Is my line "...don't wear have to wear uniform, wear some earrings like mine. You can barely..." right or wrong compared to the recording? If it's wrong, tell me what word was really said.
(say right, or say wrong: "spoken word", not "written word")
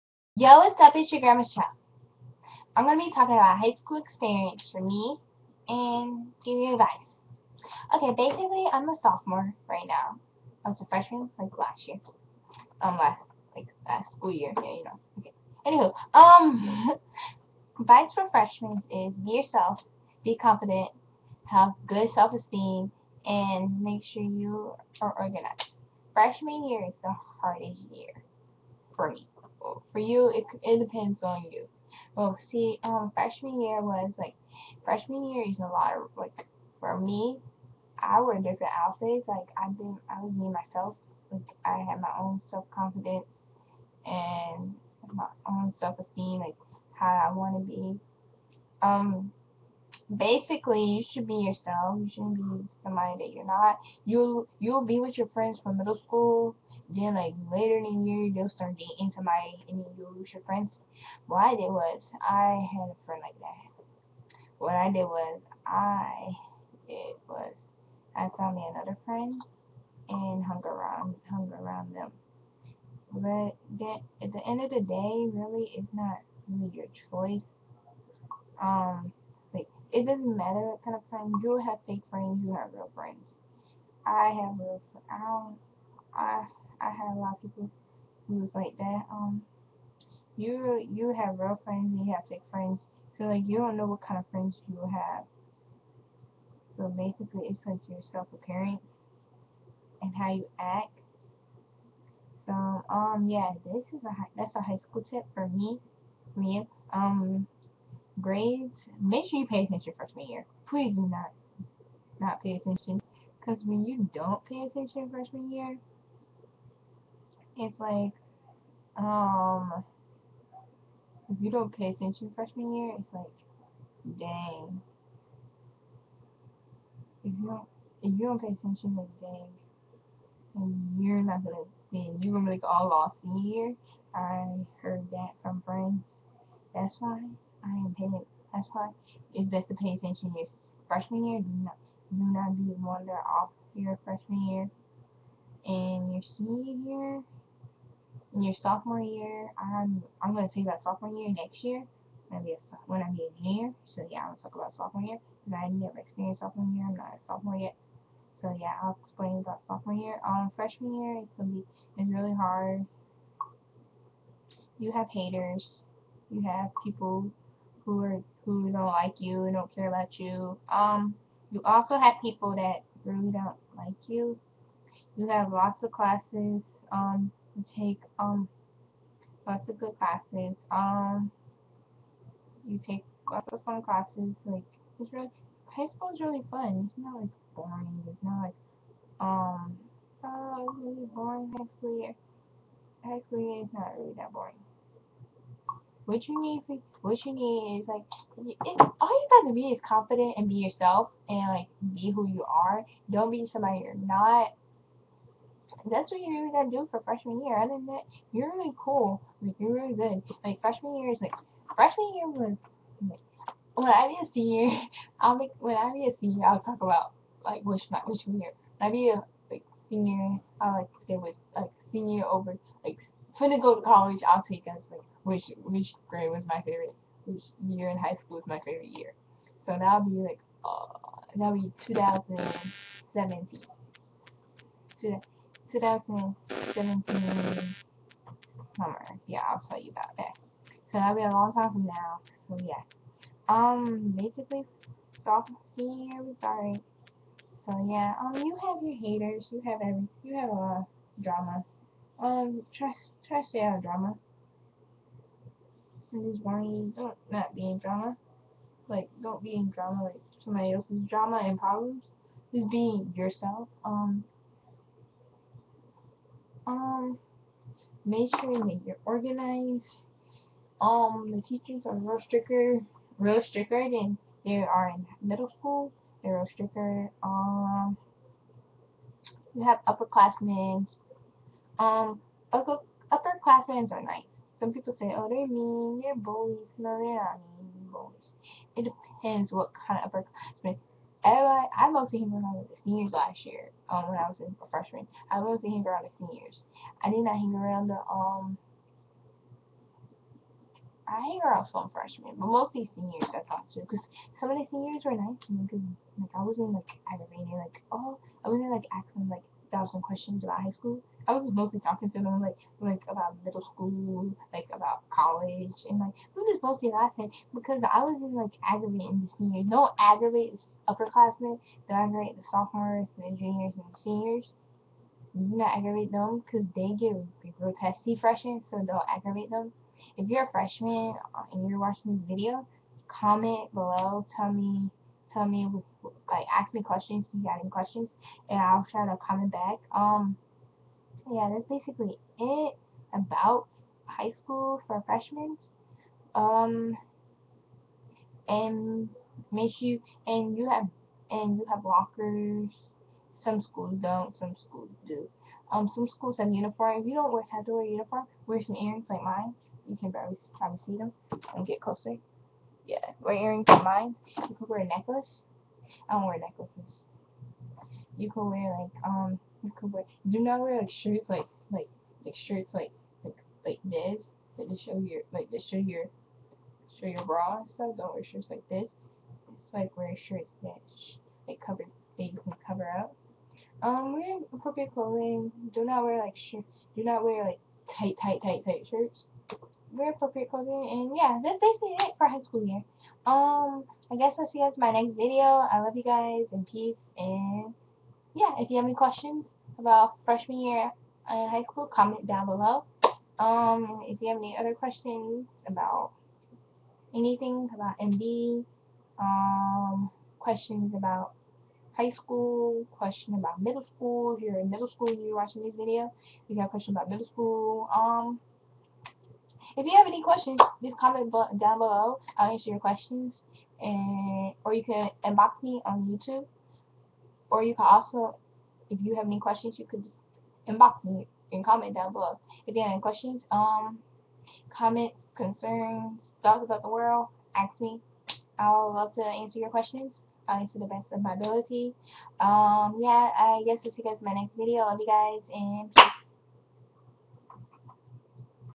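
right.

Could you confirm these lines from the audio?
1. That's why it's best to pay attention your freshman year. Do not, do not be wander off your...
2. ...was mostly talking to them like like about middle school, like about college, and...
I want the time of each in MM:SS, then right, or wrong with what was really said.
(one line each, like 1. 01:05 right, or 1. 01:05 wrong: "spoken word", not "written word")
1. 02:18 right
2. 05:11 right.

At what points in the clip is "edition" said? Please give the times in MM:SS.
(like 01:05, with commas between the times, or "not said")
not said.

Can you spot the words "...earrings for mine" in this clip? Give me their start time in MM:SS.
06:03.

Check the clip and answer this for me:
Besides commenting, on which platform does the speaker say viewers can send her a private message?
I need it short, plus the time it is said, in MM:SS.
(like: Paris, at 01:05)
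YouTube, at 07:06.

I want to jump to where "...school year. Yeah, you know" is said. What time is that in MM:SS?
00:14.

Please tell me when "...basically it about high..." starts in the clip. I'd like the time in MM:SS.
05:41.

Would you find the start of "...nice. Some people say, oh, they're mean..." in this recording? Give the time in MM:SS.
04:44.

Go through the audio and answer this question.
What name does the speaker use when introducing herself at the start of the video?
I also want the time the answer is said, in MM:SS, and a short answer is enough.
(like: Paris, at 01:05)
Michelle, at 00:01.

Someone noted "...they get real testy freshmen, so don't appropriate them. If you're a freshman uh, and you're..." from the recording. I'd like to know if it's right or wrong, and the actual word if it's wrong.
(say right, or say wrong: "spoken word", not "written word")
wrong: "aggravate", not "appropriate".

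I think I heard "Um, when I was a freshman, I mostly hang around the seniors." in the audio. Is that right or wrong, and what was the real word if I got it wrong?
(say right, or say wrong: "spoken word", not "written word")
right.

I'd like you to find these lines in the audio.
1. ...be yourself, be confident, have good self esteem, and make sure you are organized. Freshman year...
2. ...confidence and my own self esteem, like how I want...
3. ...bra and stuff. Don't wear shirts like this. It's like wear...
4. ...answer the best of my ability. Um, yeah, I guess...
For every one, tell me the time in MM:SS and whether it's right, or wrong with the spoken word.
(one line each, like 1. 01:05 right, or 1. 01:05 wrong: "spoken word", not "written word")
1. 00:19 right
2. 00:42 right
3. 06:17 right
4. 07:20 right.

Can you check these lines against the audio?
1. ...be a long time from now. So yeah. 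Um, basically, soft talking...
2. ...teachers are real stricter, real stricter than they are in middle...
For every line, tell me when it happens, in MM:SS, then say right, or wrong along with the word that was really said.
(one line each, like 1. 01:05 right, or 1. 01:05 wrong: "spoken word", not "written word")
1. 04:01 wrong: "seeing", not "talking"
2. 04:31 right.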